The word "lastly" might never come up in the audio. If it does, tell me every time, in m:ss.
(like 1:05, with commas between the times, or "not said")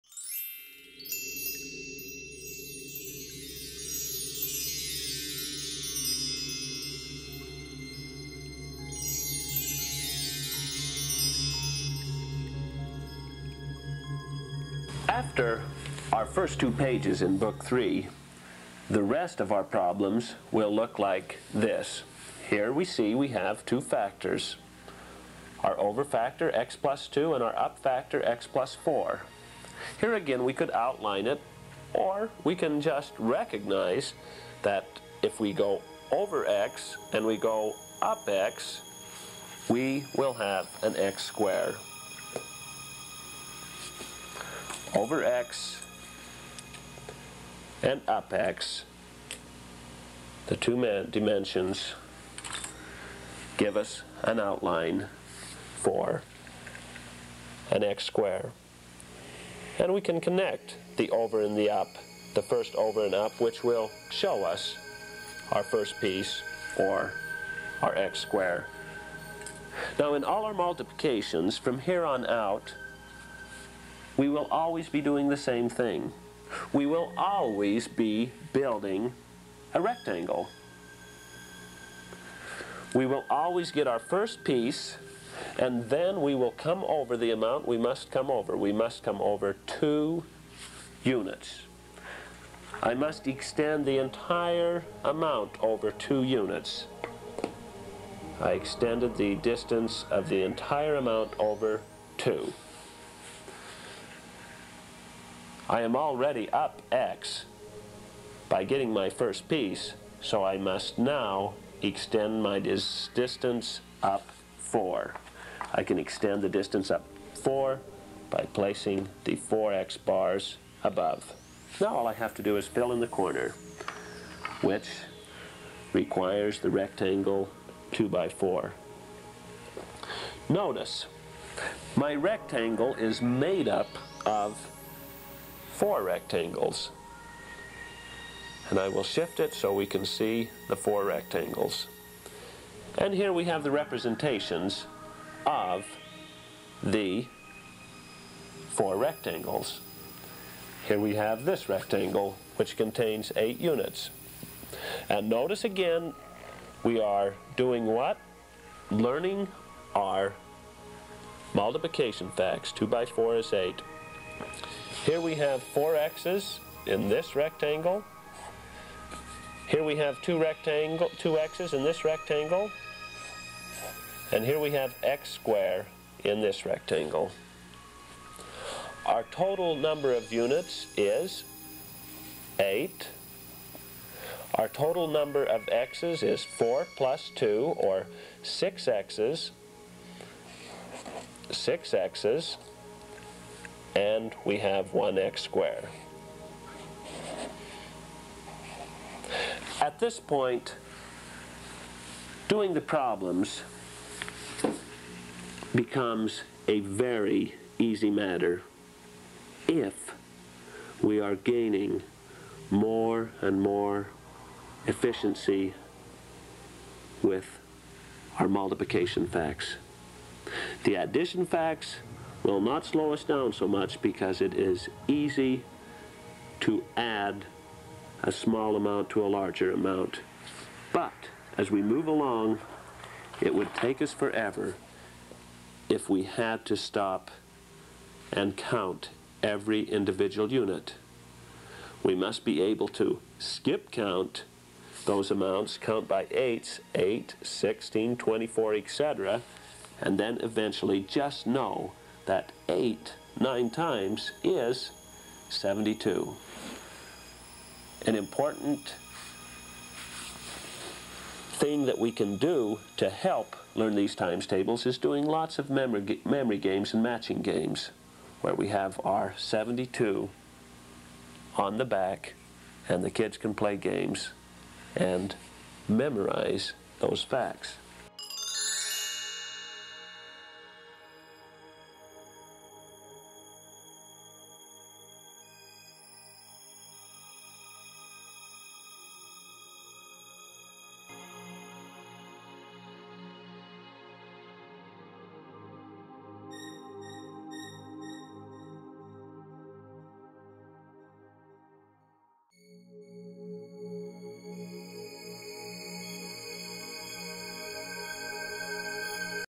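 not said.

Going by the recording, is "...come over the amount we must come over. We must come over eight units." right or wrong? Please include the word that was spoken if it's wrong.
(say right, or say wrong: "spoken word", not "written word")
wrong: "two", not "eight".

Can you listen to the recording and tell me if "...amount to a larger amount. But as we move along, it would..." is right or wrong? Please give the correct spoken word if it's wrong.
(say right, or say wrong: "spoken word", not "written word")
right.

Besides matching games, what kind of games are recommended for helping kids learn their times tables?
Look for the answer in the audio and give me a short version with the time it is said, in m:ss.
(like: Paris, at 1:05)
memory games, at 4:26.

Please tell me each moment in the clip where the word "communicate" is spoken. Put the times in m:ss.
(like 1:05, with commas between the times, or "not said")
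not said.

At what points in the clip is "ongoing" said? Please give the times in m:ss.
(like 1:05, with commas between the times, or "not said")
not said.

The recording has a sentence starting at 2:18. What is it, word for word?
And I will shift it so we can see the four rectangles.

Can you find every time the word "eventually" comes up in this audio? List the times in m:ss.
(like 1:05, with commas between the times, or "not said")
4:10.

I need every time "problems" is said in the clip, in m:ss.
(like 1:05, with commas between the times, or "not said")
0:19, 3:22.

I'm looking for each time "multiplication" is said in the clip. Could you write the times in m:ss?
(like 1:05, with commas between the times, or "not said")
1:10, 2:41, 3:38.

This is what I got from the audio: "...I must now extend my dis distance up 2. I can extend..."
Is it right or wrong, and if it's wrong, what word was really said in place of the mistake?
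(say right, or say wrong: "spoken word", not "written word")
wrong: "4", not "2".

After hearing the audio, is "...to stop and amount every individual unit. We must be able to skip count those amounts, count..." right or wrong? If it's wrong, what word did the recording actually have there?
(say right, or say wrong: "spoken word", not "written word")
wrong: "count", not "amount".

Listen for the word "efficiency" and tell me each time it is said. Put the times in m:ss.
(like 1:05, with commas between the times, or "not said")
3:34.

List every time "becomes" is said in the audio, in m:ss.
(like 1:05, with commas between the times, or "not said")
3:25.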